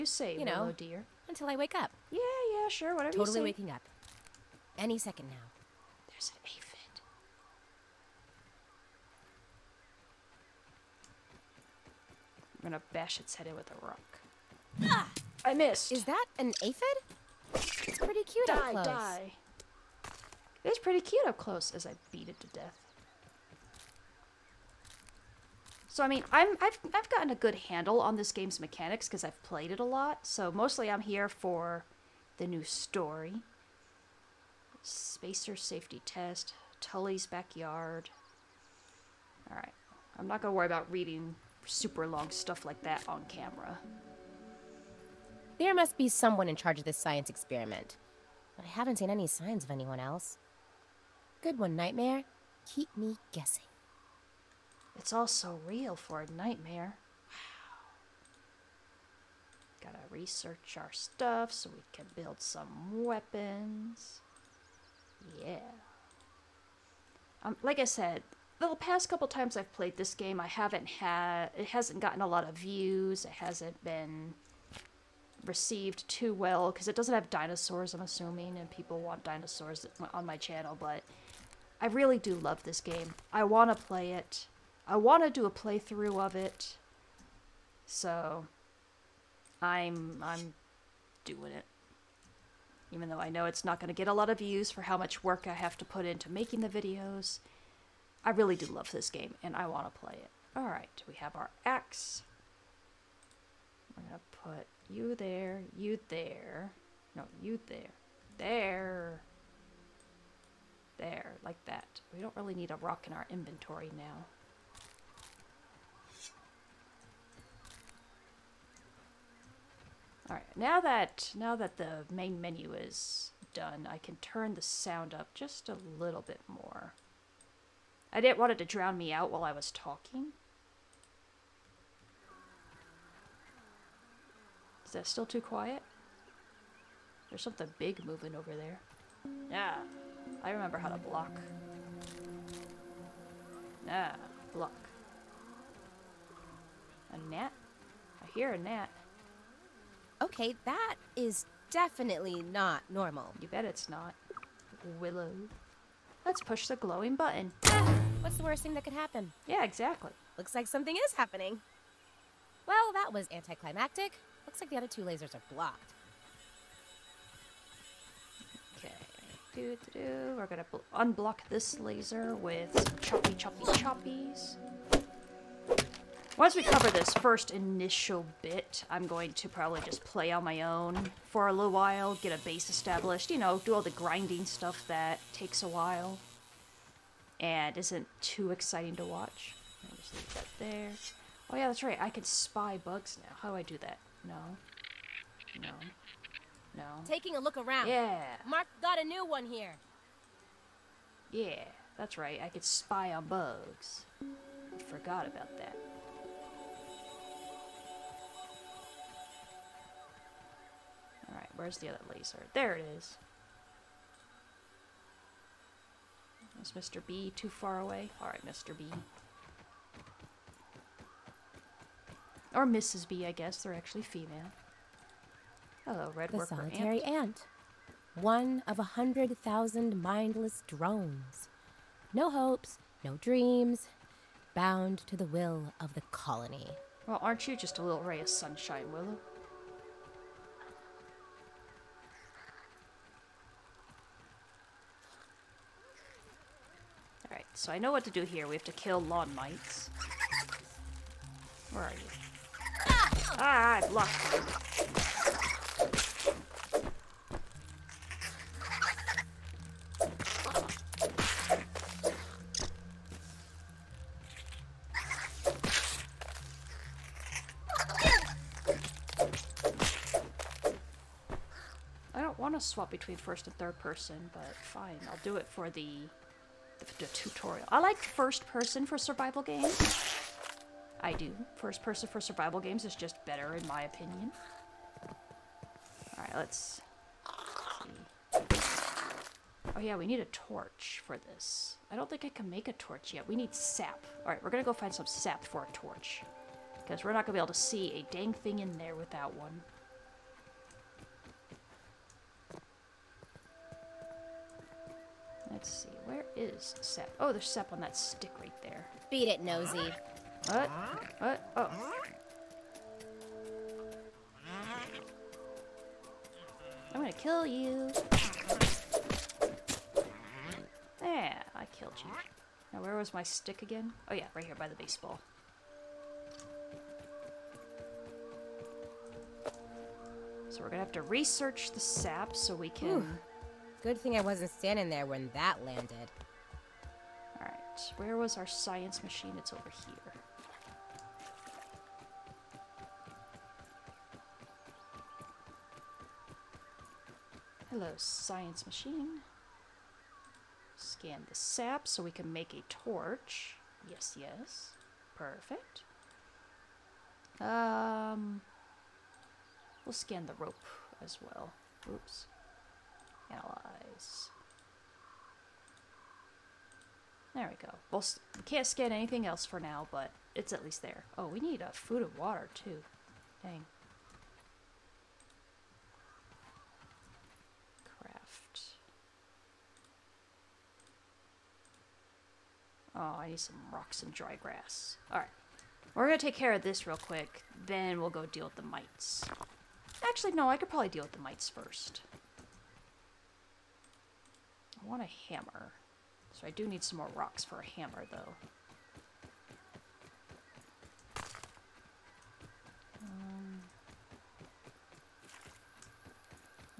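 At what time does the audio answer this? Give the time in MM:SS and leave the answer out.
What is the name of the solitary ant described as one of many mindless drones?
03:46.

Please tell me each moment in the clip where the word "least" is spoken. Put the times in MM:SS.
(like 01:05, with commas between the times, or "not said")
06:10.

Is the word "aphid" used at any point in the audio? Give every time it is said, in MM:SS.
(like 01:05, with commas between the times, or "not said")
00:06, 00:16.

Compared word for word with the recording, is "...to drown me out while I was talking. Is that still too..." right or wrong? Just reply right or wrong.
right.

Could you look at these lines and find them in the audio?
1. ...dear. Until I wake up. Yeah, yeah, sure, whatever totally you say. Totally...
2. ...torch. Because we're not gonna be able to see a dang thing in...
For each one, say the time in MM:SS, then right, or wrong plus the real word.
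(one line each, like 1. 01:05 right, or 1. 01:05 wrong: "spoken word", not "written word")
1. 00:00 right
2. 04:55 right.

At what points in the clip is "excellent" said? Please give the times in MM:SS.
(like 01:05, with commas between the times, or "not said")
not said.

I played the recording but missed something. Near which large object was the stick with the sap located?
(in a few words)
The baseball.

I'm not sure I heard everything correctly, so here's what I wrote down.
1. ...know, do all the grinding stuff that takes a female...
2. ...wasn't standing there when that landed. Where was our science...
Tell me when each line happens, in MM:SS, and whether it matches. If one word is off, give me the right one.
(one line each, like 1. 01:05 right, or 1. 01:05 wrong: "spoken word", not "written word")
1. 03:03 wrong: "while", not "female"
2. 05:34 right.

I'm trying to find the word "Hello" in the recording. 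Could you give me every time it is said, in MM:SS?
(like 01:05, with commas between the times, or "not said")
03:45, 05:47.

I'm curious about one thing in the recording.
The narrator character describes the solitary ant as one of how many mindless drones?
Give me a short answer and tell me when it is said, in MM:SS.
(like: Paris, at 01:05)
100,000, at 03:48.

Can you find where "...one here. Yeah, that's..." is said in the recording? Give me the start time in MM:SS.
03:19.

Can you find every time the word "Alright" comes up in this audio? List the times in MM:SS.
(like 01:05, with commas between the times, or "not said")
00:39, 02:00, 03:31, 03:38, 04:07, 04:46, 04:54, 06:25.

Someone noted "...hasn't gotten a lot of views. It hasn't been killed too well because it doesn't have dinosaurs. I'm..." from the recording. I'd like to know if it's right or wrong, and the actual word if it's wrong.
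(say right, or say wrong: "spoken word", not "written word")
wrong: "received", not "killed".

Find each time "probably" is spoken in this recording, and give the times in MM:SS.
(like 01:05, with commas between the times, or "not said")
02:59, 06:30.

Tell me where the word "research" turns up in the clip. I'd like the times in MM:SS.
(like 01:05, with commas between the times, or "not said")
01:00, 05:31.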